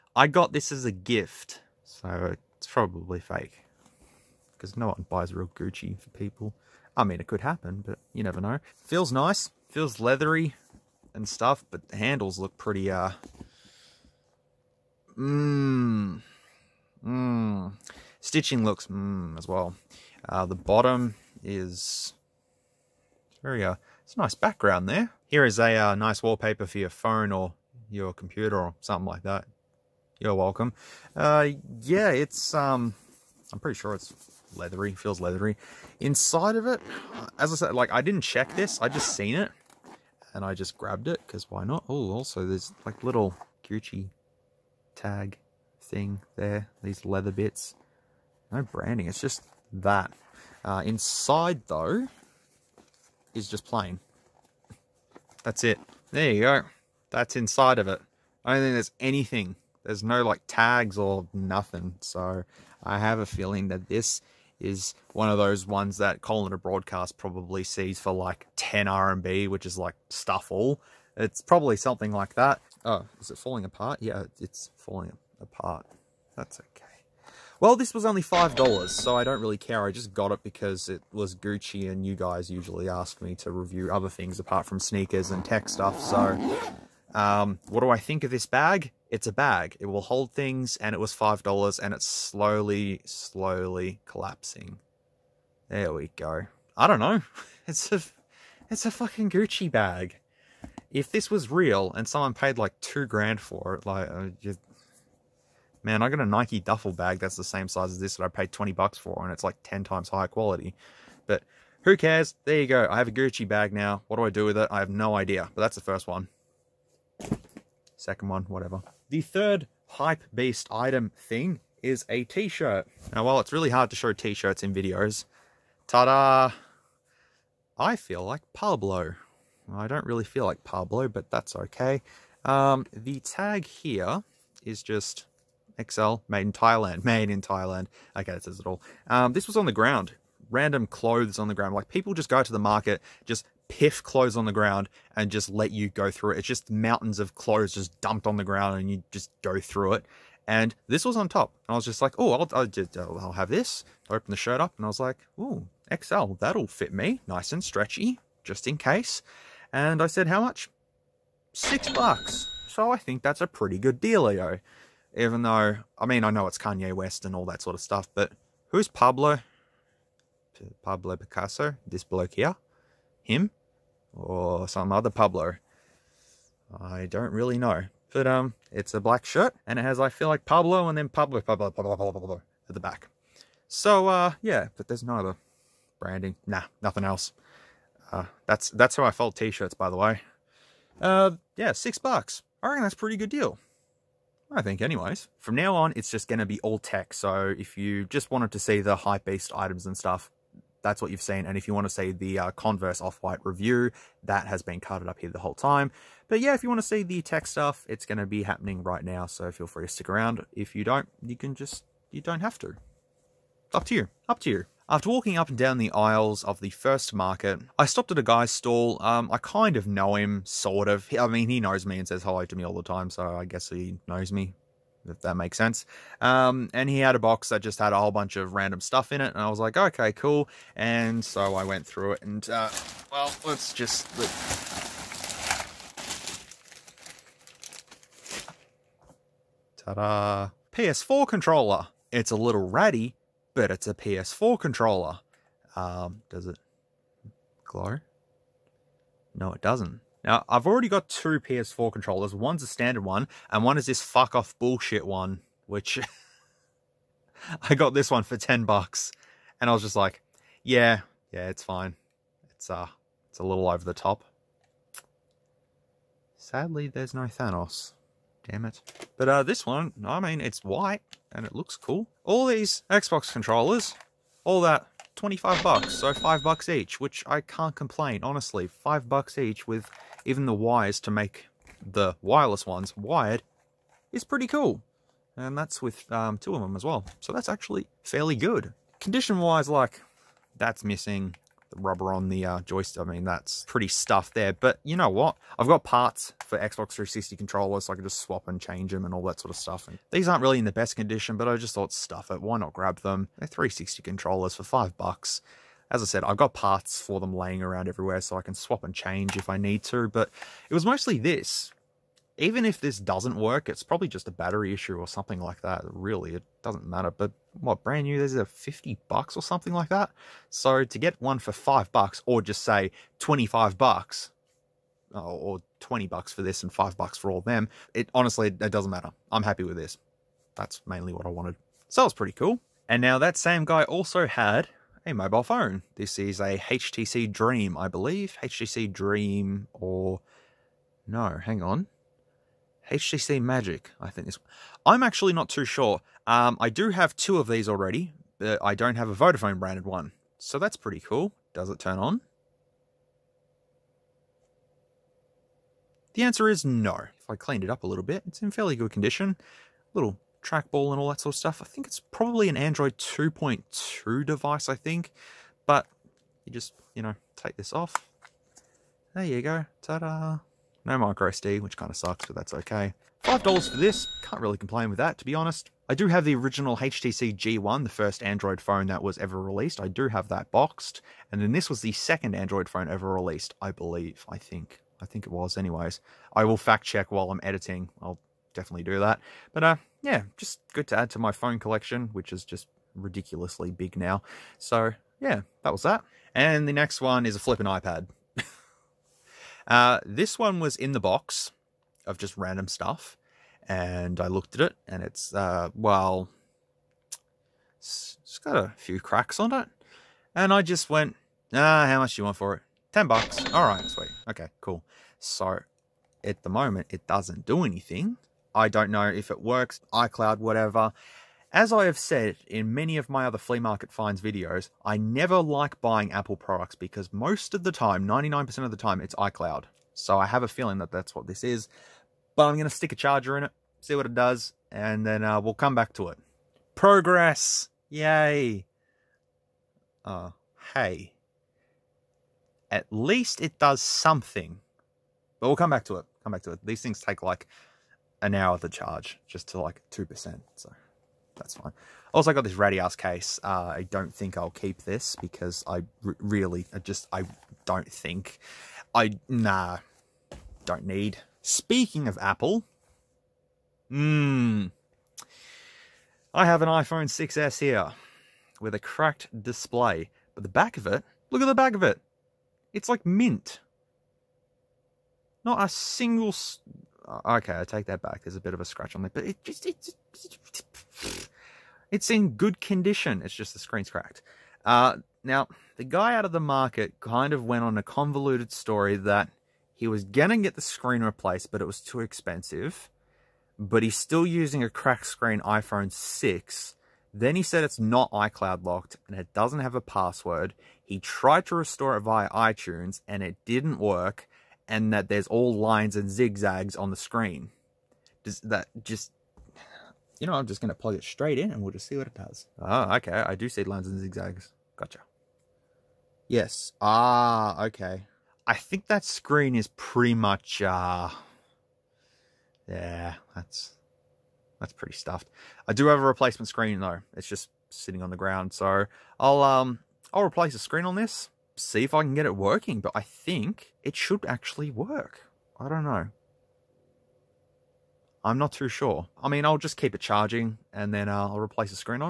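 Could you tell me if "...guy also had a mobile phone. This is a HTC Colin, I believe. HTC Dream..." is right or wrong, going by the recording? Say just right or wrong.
wrong.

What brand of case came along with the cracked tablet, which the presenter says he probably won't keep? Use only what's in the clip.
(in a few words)
Radius.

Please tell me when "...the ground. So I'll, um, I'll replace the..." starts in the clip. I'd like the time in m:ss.
8:48.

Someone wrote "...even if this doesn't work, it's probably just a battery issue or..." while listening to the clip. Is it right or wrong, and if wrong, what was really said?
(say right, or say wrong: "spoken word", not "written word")
right.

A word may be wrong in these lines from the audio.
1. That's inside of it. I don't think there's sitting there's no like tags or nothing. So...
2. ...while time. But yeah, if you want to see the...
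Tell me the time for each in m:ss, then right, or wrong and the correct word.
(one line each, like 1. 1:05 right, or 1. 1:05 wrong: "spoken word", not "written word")
1. 0:57 wrong: "anything", not "sitting"
2. 3:25 wrong: "whole", not "while".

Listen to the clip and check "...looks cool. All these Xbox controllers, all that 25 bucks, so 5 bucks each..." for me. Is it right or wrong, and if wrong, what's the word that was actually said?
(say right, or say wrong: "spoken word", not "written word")
right.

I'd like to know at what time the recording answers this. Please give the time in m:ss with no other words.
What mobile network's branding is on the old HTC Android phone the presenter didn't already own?
5:49.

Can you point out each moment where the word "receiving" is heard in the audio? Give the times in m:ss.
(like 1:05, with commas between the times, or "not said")
not said.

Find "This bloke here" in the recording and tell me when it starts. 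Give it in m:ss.
2:51.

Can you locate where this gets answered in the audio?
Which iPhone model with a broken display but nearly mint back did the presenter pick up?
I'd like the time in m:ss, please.
7:46.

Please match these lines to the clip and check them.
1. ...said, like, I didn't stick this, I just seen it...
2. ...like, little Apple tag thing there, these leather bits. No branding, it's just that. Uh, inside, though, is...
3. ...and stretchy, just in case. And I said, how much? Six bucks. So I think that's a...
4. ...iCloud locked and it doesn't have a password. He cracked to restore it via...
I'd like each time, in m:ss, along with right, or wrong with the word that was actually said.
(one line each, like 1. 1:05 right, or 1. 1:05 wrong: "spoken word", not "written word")
1. 0:37 wrong: "check", not "stick"
2. 0:42 wrong: "Gucci", not "Apple"
3. 2:37 right
4. 8:18 wrong: "tried", not "cracked".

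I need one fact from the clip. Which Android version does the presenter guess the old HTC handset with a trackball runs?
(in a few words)
Android 2.2.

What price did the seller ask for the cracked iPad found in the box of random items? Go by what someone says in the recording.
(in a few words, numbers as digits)
Ten bucks.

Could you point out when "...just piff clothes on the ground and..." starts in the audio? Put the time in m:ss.
2:23.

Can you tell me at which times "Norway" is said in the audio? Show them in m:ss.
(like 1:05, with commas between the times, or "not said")
not said.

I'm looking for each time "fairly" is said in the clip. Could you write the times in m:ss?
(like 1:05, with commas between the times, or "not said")
4:48, 5:58.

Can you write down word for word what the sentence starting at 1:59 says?
The third hype beast item thing is a t-shirt.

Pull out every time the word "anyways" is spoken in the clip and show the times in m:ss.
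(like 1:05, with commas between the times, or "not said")
3:14, 6:25.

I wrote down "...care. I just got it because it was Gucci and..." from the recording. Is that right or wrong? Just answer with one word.
right.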